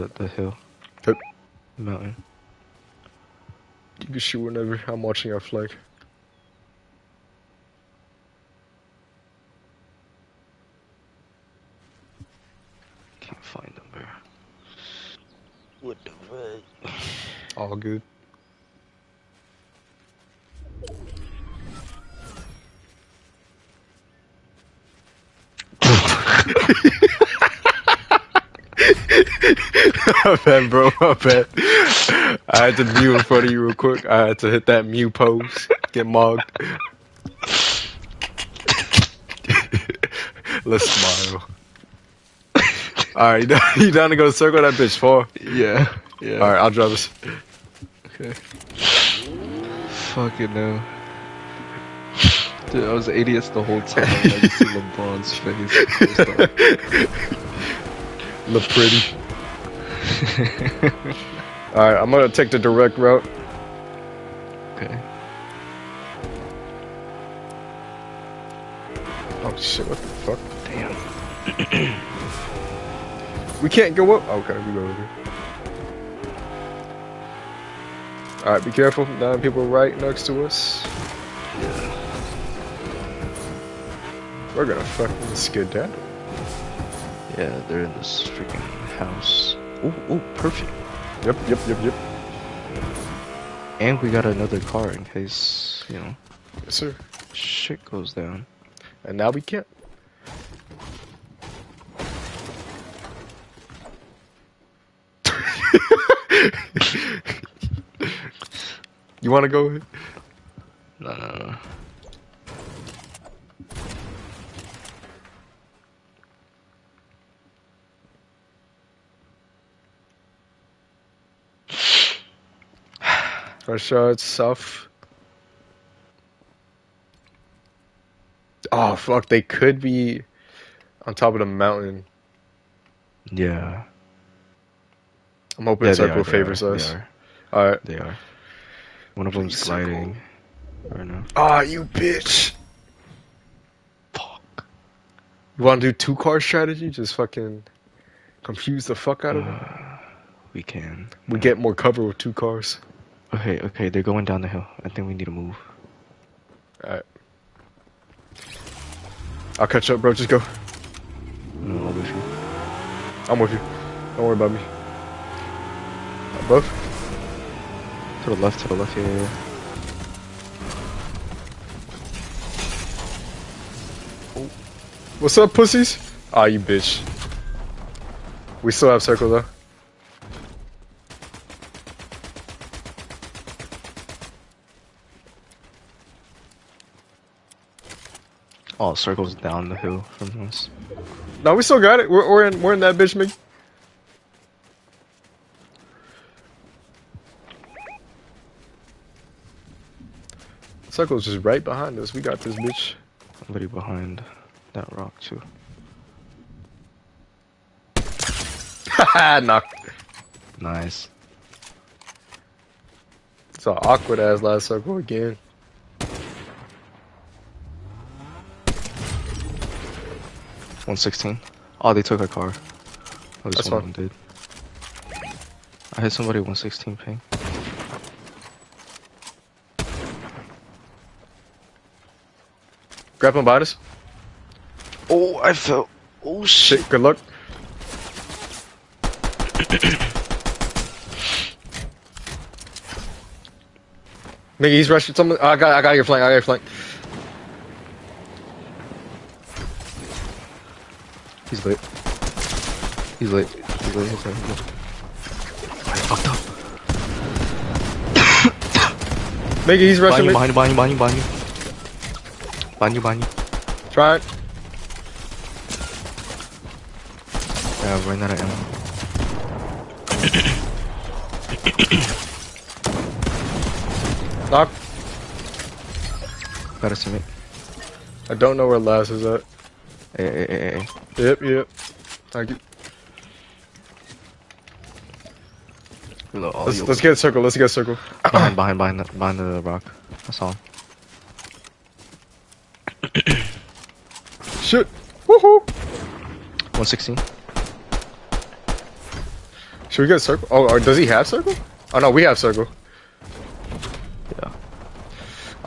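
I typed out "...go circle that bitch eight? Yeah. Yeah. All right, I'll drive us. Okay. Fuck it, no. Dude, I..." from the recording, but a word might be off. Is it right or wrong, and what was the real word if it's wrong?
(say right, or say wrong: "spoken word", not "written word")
wrong: "four", not "eight".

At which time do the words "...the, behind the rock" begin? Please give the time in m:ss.
4:48.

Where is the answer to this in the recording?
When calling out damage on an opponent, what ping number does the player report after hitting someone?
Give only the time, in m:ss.
3:46.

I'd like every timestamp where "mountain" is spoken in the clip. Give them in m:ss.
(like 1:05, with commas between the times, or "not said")
0:01, 2:11.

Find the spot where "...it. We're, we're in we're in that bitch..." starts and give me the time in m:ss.
3:11.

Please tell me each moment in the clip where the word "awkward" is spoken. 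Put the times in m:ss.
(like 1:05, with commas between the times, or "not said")
3:33.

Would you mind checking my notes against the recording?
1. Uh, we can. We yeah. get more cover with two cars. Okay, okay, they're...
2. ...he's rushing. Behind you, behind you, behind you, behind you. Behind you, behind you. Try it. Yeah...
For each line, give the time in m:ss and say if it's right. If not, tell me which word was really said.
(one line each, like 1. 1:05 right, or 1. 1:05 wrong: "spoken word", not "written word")
1. 2:29 right
2. 4:19 right.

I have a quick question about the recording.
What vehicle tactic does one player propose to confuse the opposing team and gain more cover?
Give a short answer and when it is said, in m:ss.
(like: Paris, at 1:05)
Two car strategy, at 2:25.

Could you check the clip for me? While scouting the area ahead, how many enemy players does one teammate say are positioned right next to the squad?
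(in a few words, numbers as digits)
9.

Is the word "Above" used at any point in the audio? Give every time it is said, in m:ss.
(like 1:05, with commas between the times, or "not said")
2:46.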